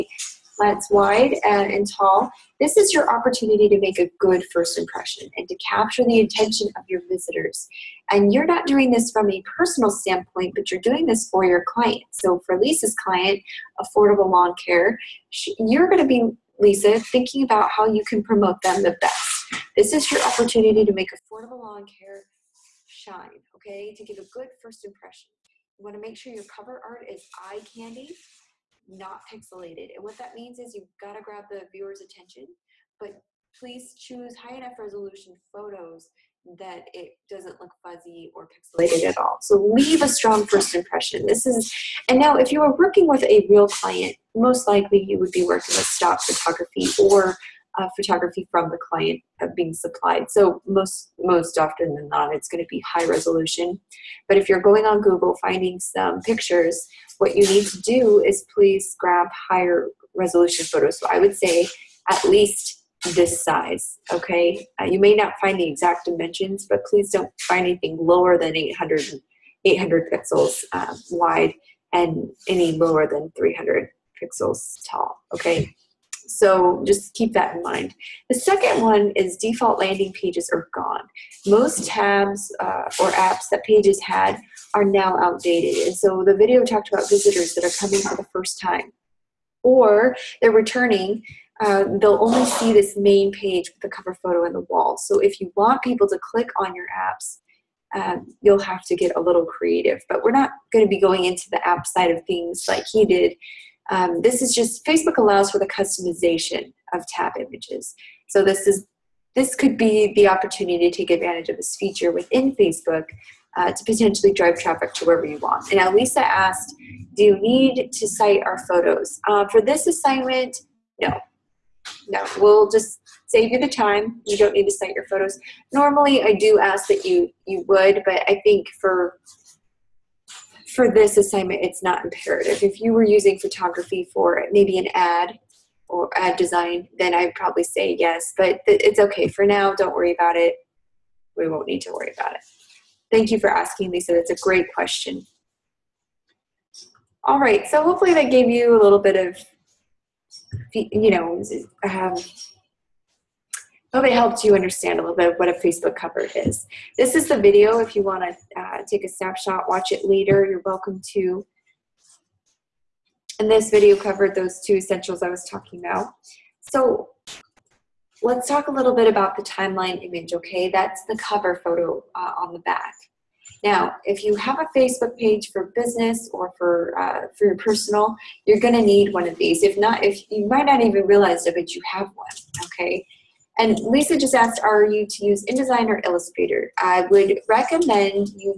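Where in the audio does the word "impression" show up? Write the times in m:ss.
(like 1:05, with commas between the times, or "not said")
0:04, 0:24, 0:40.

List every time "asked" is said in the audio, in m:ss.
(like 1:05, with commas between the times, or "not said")
1:56, 3:04.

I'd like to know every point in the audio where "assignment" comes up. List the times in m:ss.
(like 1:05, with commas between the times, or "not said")
1:59, 2:11.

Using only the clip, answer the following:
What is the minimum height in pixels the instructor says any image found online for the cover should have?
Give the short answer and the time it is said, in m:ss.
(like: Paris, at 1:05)
300, at 1:13.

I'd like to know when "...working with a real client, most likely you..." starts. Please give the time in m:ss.
0:42.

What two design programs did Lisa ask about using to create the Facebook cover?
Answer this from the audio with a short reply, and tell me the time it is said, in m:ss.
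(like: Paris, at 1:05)
InDesign or Illustrator, at 3:05.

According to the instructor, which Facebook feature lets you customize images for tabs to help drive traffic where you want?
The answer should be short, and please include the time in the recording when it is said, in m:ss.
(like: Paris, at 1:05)
tab images, at 1:47.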